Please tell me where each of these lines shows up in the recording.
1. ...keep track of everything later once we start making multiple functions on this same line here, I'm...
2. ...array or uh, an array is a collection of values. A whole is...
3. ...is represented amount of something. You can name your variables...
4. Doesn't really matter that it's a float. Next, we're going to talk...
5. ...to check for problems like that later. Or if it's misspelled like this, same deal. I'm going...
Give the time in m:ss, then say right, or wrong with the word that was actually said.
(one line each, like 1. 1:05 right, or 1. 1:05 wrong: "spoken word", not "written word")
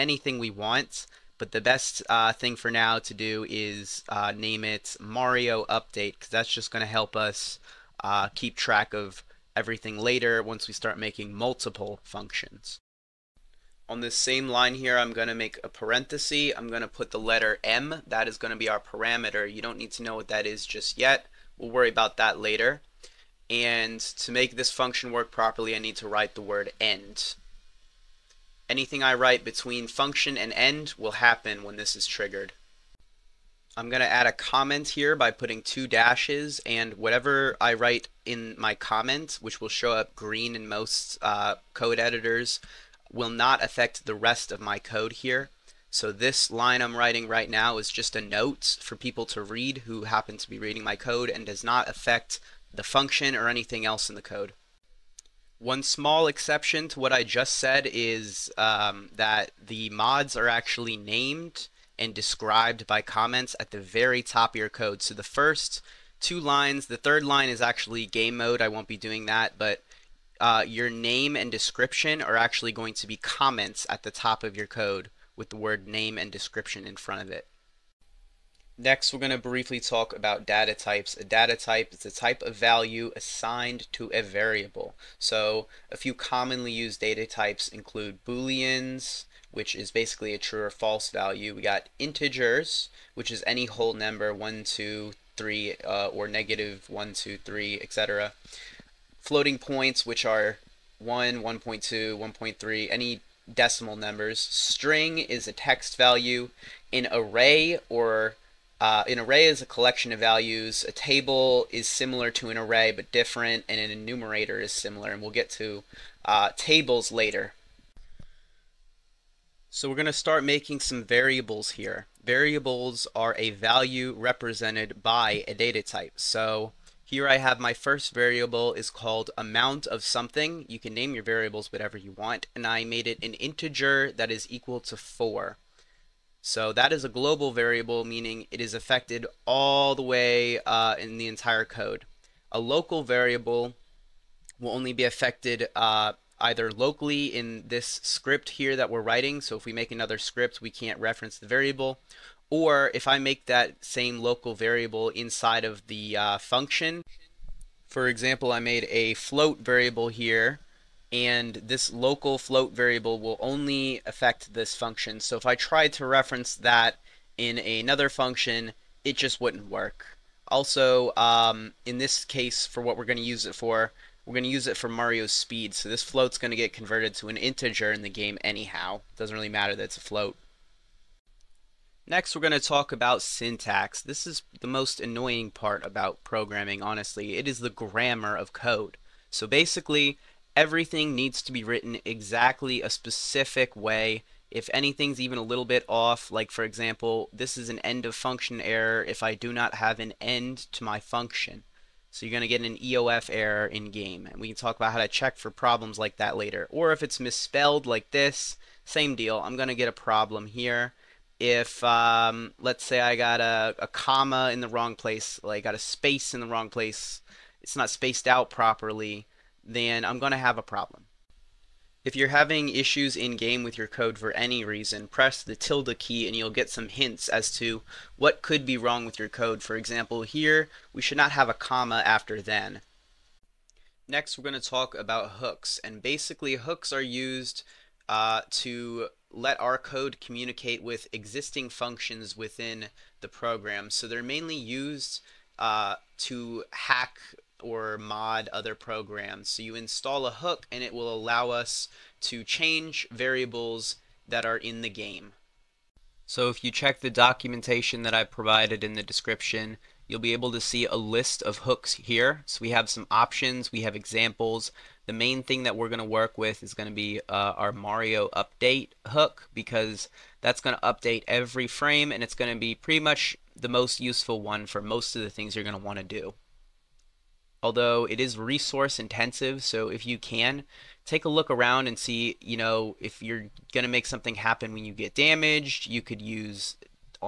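1. 0:08 right
2. 1:47 wrong: "table", not "whole"
3. 2:08 wrong: "called", not "represented"
4. 2:59 right
5. 3:24 right.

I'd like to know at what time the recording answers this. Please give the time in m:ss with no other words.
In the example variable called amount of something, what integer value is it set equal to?
2:14.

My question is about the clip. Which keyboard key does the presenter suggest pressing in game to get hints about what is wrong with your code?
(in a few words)
tilde.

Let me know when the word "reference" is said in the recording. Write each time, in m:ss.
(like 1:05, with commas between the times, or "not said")
2:30, 2:46.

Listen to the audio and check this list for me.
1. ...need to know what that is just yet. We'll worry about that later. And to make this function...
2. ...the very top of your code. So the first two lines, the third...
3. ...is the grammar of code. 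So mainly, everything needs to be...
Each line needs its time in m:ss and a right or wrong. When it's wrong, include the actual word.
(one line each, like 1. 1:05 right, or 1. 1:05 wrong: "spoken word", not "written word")
1. 0:19 right
2. 1:03 right
3. 3:07 wrong: "basically", not "mainly".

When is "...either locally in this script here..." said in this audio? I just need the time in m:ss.
2:26.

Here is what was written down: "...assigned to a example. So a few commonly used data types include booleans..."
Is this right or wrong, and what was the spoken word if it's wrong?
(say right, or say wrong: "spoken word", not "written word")
wrong: "variable", not "example".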